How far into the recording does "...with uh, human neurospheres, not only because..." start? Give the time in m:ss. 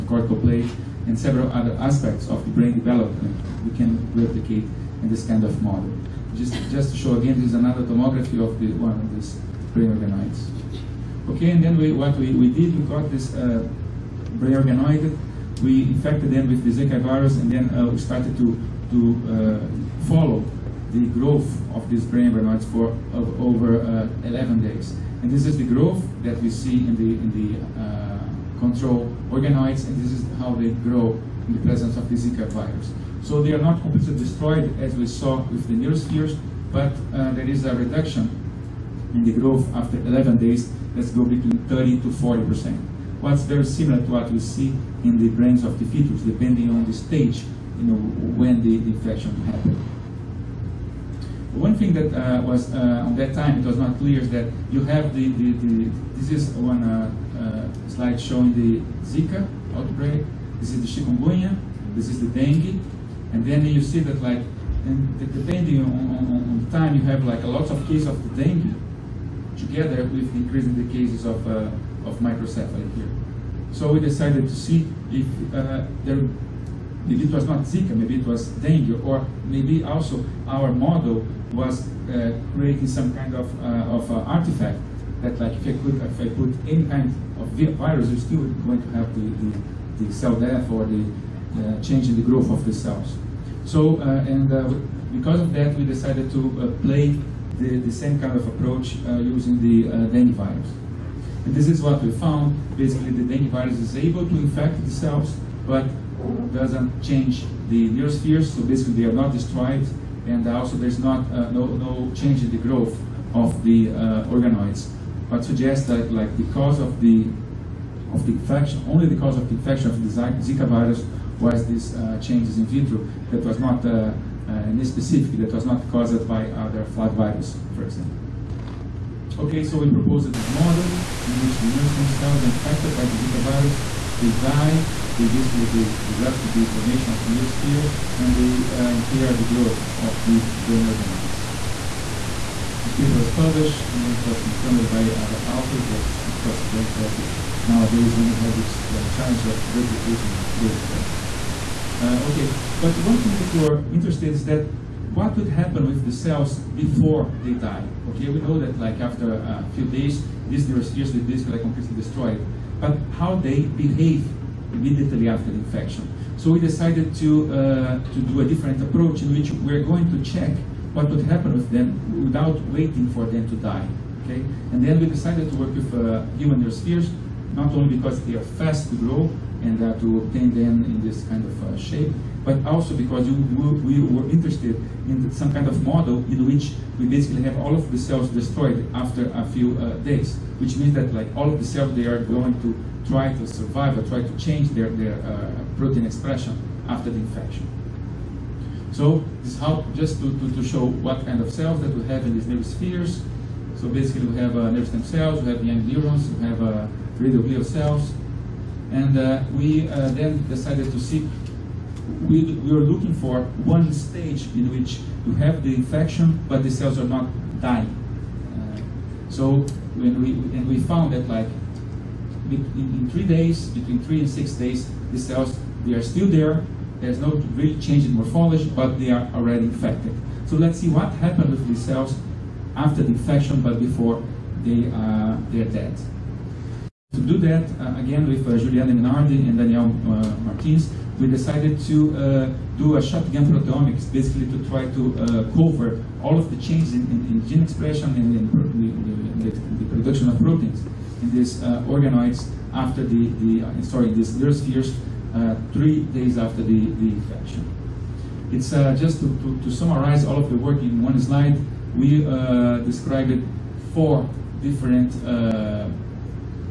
2:55.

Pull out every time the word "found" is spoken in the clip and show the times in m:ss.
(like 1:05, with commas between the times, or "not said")
1:42, 3:40.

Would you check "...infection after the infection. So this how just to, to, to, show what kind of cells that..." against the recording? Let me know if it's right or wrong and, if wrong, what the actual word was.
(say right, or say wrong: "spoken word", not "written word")
wrong: "expression", not "infection".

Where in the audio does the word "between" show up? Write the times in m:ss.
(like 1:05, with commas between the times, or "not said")
0:41, 3:43.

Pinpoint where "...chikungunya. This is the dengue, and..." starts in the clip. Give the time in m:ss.
1:01.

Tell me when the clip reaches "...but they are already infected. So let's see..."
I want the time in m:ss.
3:48.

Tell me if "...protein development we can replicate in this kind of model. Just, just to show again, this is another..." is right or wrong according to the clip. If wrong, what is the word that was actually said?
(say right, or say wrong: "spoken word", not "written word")
wrong: "brain", not "protein".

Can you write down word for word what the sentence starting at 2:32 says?
Uh, okay, but one thing that we're interested in is that what would happen with the cells before they die?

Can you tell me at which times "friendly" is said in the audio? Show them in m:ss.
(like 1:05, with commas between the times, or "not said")
not said.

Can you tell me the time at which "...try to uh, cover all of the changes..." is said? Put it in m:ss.
4:04.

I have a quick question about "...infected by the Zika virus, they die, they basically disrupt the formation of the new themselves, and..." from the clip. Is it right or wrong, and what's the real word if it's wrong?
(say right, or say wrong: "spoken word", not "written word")
wrong: "spheres", not "themselves".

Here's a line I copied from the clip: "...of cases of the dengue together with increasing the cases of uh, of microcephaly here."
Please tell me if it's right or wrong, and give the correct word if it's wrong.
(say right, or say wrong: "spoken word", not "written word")
right.